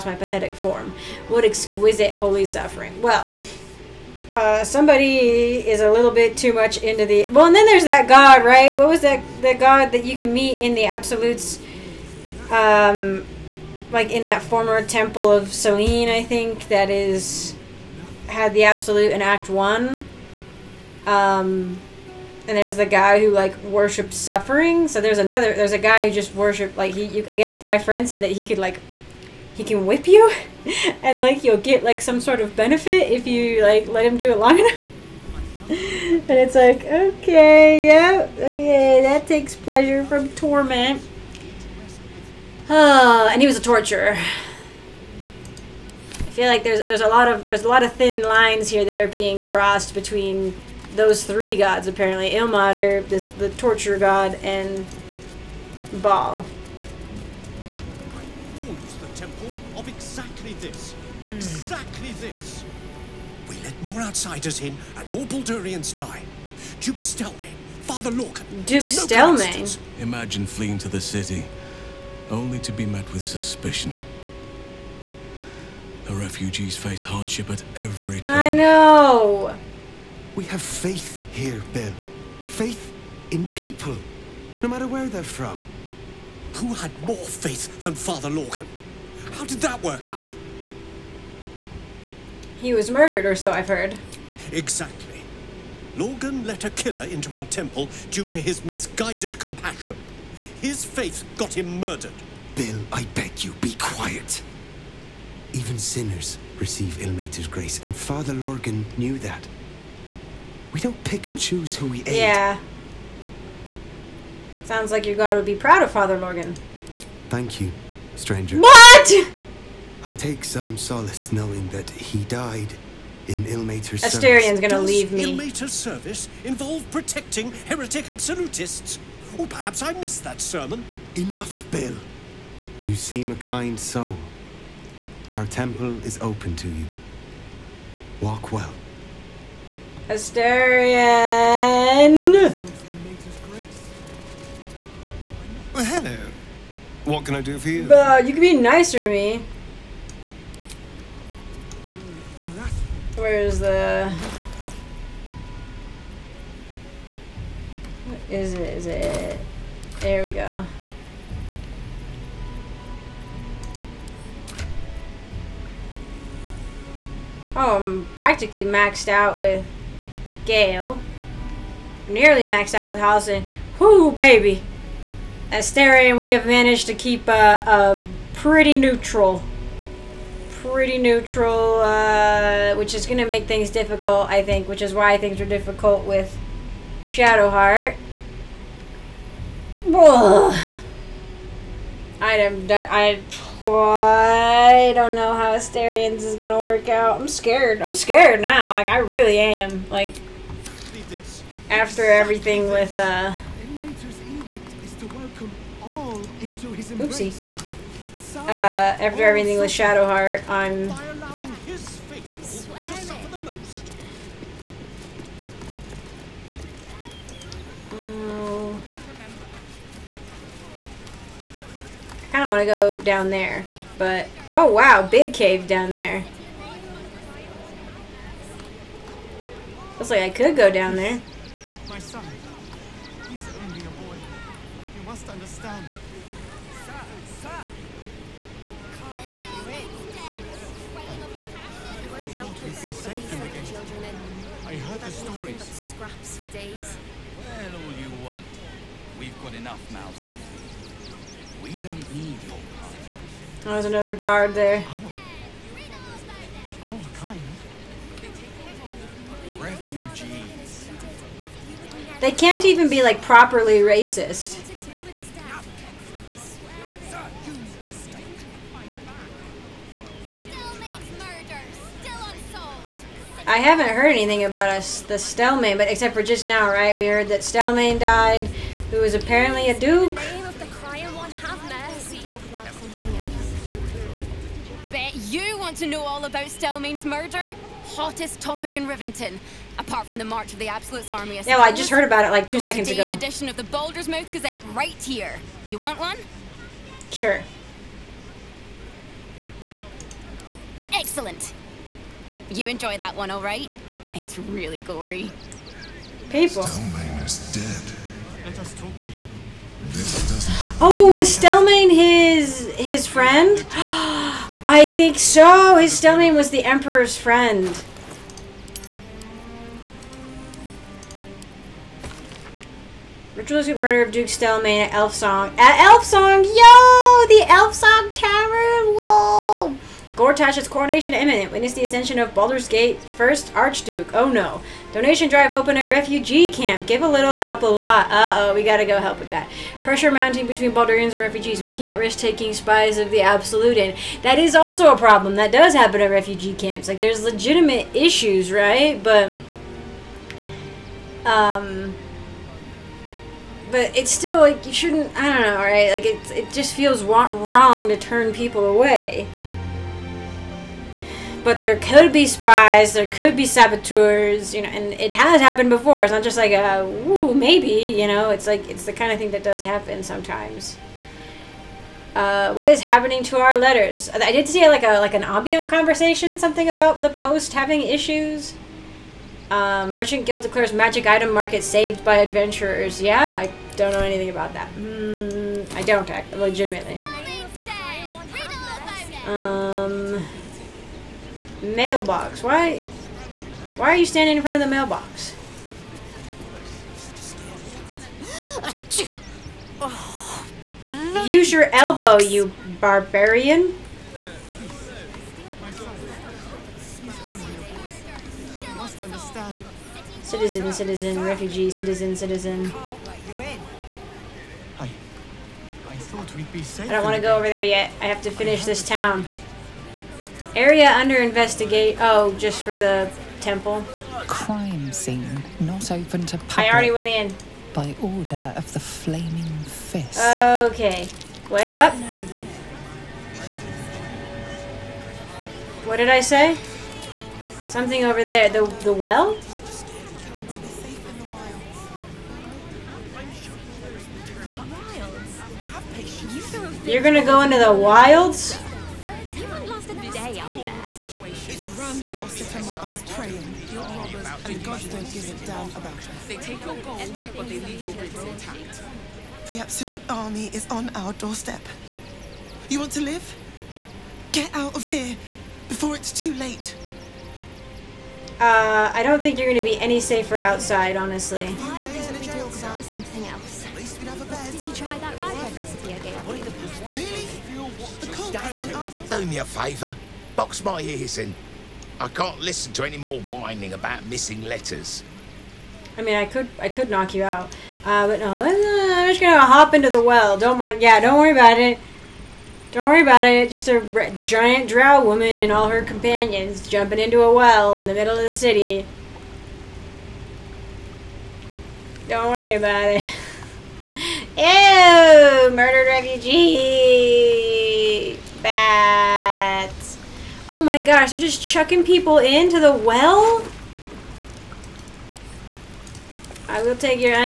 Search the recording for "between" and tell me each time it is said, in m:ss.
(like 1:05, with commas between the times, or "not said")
0:49, 5:40.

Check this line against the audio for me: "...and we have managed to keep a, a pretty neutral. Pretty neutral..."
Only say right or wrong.
right.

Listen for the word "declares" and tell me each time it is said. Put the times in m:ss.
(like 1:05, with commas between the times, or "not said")
6:20.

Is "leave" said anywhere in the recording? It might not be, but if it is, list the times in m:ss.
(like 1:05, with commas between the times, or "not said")
2:04, 7:37.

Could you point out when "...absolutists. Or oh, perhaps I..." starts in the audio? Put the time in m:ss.
2:08.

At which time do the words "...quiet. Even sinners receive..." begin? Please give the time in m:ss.
1:43.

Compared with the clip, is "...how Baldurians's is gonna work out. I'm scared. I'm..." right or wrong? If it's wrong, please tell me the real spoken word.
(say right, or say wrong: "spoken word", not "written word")
wrong: "Astarion", not "Baldurians".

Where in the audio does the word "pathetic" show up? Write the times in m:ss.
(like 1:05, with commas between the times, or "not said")
0:00.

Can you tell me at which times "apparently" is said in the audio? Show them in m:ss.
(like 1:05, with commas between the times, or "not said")
0:51, 4:39.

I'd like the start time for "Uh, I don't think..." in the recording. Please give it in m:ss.
7:48.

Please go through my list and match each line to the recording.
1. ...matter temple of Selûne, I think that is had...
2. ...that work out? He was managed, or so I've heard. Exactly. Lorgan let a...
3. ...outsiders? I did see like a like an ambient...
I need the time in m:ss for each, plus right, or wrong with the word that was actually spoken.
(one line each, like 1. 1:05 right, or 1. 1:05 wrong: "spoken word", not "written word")
1. 0:14 wrong: "former", not "matter"
2. 1:29 wrong: "murdered", not "managed"
3. 6:13 wrong: "letters", not "outsiders".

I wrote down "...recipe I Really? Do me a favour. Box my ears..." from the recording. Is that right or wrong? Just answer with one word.
right.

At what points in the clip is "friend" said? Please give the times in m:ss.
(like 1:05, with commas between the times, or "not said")
0:27, 5:13, 5:17.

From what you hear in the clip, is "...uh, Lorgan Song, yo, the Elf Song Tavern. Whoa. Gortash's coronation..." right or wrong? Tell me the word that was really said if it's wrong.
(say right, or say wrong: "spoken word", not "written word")
wrong: "Elf", not "Lorgan".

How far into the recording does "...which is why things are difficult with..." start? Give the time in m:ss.
3:04.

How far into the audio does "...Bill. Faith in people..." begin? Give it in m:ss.
1:21.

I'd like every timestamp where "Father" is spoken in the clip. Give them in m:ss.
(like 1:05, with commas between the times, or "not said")
1:07, 1:27, 1:47, 1:55.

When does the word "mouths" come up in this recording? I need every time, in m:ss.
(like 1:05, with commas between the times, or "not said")
4:09, 4:54.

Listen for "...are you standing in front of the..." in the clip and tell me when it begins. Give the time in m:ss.
6:33.